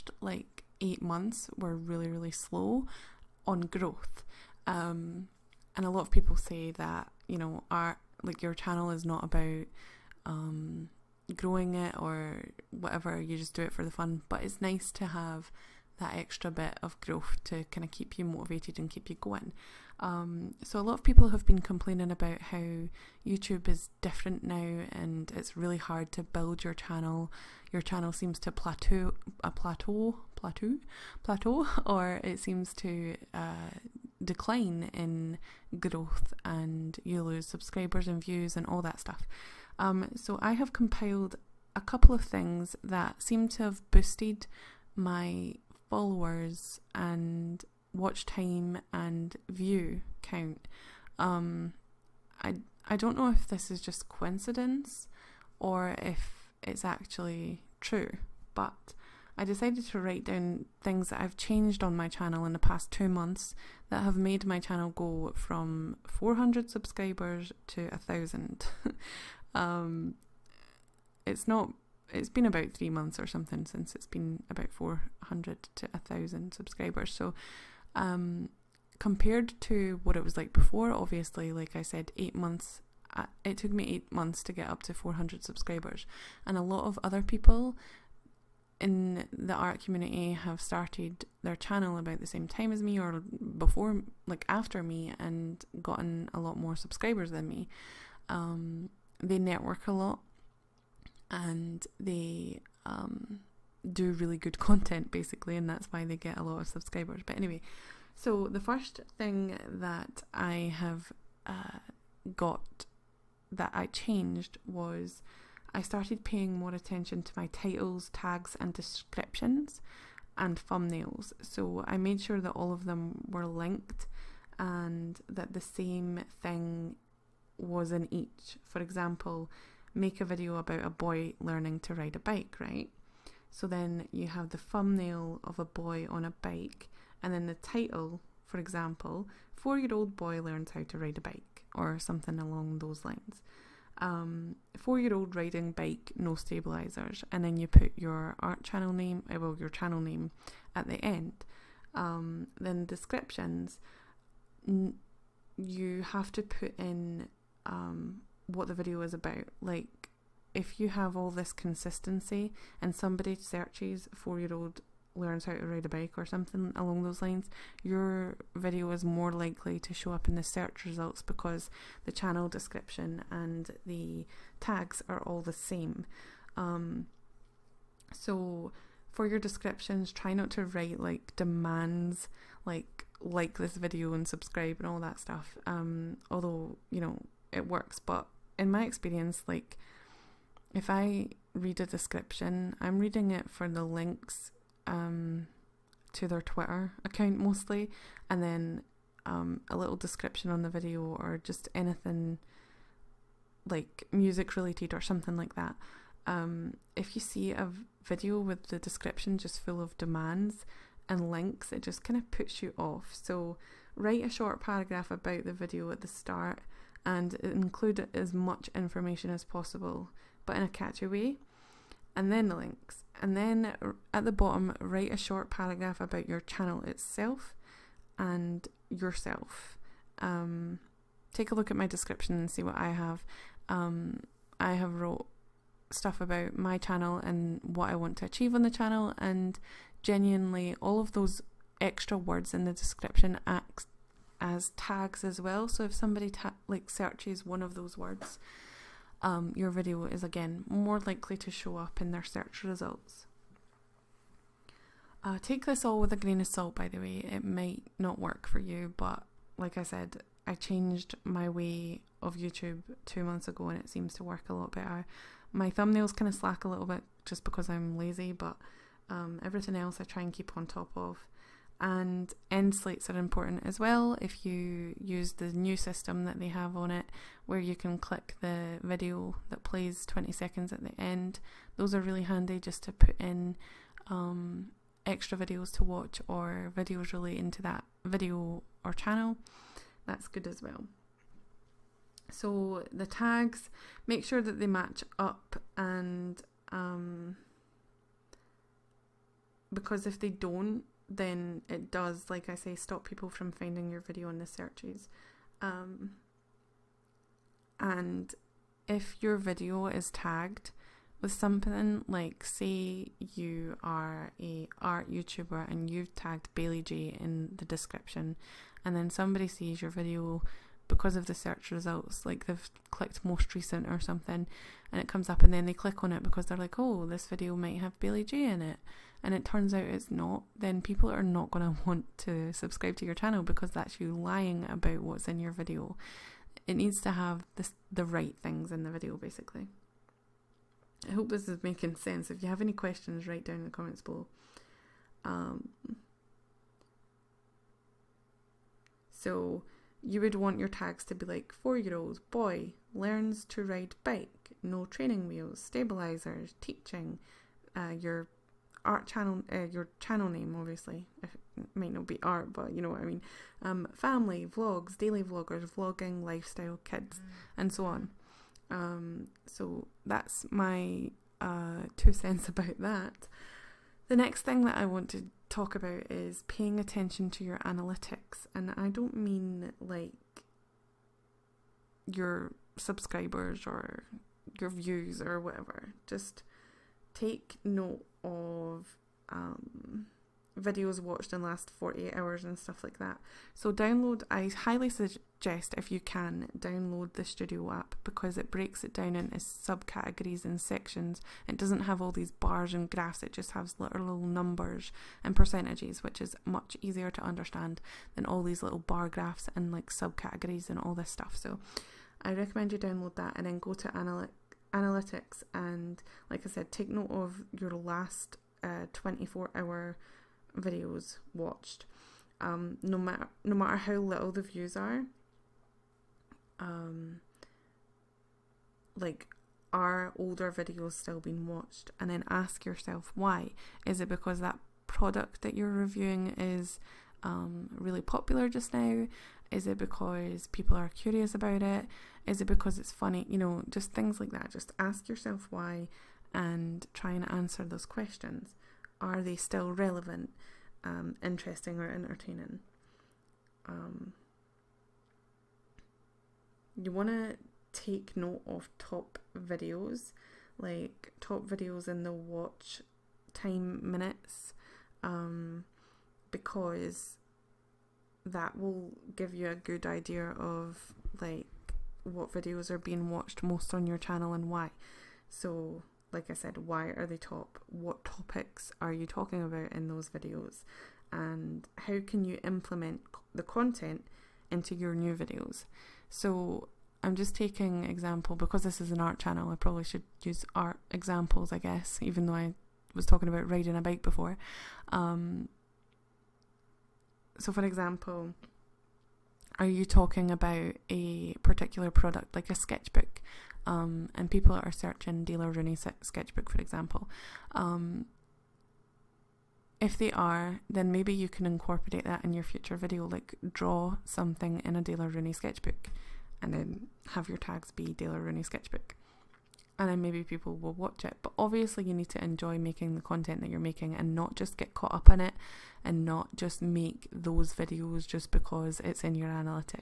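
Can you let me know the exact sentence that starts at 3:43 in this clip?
And then at the bottom, write a short paragraph about your channel itself and yourself.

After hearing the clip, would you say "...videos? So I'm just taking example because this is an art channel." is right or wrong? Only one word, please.
right.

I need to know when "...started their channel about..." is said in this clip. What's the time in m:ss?
1:30.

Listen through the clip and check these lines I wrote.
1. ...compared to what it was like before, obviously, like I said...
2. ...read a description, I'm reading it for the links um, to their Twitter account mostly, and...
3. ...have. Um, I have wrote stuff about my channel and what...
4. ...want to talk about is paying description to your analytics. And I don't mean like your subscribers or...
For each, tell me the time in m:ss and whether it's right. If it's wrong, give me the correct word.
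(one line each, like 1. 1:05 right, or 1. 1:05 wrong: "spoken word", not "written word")
1. 1:18 right
2. 3:11 right
3. 3:52 right
4. 6:14 wrong: "attention", not "description".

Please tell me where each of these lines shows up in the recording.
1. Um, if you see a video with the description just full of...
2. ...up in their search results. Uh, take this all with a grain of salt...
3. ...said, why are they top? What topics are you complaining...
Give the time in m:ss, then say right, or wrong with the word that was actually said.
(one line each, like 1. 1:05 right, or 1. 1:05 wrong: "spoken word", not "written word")
1. 3:26 right
2. 4:11 right
3. 7:56 wrong: "talking", not "complaining".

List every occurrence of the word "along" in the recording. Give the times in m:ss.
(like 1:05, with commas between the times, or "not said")
2:22, 2:46.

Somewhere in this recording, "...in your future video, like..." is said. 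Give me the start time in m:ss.
8:32.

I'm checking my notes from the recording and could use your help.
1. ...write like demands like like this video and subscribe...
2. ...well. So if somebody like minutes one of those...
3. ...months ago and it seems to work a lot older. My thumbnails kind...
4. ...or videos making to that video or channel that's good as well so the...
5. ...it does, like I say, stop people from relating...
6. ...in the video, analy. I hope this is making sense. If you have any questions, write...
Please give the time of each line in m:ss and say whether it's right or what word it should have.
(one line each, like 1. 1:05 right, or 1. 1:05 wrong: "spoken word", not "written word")
1. 3:00 right
2. 4:05 wrong: "searches", not "minutes"
3. 4:23 wrong: "better", not "older"
4. 4:46 wrong: "relating", not "making"
5. 5:01 wrong: "finding", not "relating"
6. 5:38 wrong: "basically", not "analy".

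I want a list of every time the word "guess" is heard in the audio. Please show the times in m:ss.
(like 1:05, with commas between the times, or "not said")
8:11.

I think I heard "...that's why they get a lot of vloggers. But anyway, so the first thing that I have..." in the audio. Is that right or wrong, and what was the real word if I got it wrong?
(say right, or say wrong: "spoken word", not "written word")
wrong: "subscribers", not "vloggers".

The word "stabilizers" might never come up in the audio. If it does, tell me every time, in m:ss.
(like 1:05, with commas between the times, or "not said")
2:26, 5:55.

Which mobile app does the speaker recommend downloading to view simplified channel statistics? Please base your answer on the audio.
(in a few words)
studio app.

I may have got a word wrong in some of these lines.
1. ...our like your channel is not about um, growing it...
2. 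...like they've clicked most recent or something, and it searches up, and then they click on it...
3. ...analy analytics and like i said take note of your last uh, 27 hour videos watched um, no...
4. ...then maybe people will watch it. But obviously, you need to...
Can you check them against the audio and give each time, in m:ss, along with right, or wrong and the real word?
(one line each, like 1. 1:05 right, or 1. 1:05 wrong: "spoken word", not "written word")
1. 0:07 right
2. 5:22 wrong: "comes", not "searches"
3. 6:53 wrong: "24", not "27"
4. 8:39 right.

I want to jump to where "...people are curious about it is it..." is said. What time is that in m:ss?
7:20.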